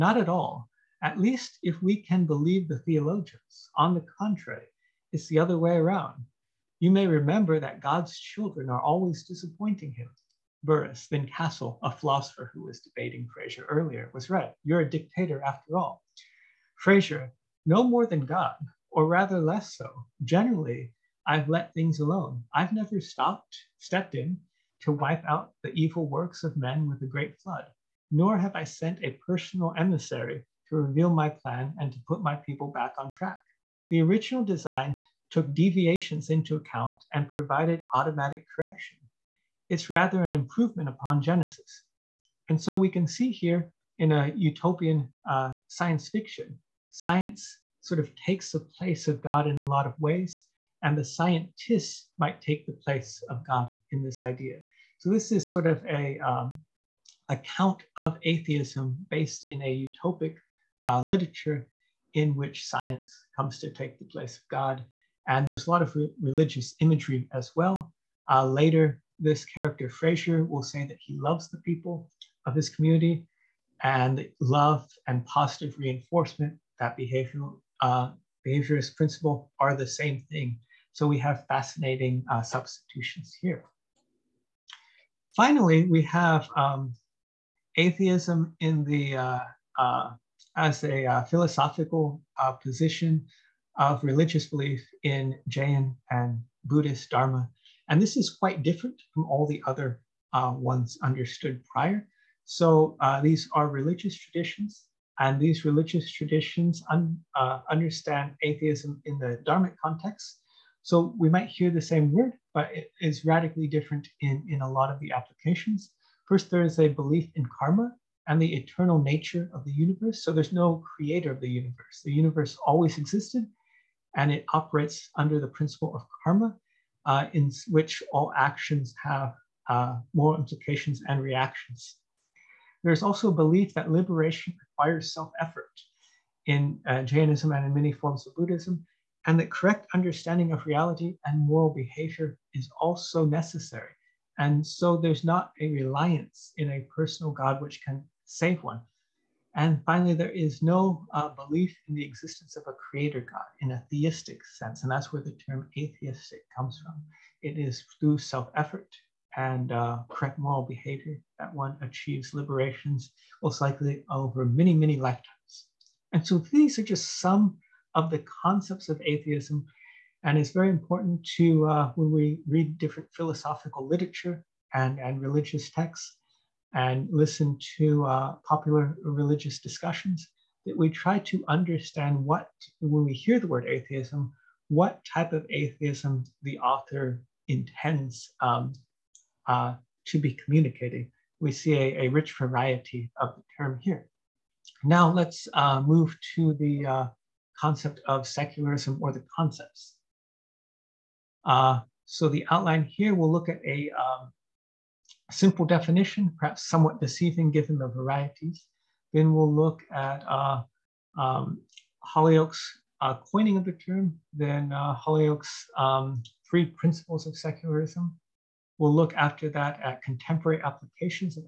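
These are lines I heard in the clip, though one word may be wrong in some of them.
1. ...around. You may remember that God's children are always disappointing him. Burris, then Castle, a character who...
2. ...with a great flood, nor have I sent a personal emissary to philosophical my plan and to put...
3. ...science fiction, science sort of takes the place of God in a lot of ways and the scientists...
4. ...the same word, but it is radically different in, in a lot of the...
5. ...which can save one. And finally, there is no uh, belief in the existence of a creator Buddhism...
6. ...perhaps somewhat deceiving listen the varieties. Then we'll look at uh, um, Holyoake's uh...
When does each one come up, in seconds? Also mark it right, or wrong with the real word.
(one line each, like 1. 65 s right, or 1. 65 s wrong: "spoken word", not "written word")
1. 5 s wrong: "philosopher", not "character"
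2. 26 s wrong: "reveal", not "philosophical"
3. 45 s right
4. 111 s right
5. 147 s wrong: "God", not "Buddhism"
6. 206 s wrong: "given", not "listen".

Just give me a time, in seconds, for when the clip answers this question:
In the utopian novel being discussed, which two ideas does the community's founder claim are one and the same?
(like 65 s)
74 s.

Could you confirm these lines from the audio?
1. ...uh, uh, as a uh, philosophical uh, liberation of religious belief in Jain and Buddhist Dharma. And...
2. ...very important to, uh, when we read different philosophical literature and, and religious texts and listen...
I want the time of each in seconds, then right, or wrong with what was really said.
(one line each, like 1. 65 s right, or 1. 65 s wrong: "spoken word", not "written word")
1. 89 s wrong: "position", not "liberation"
2. 170 s right.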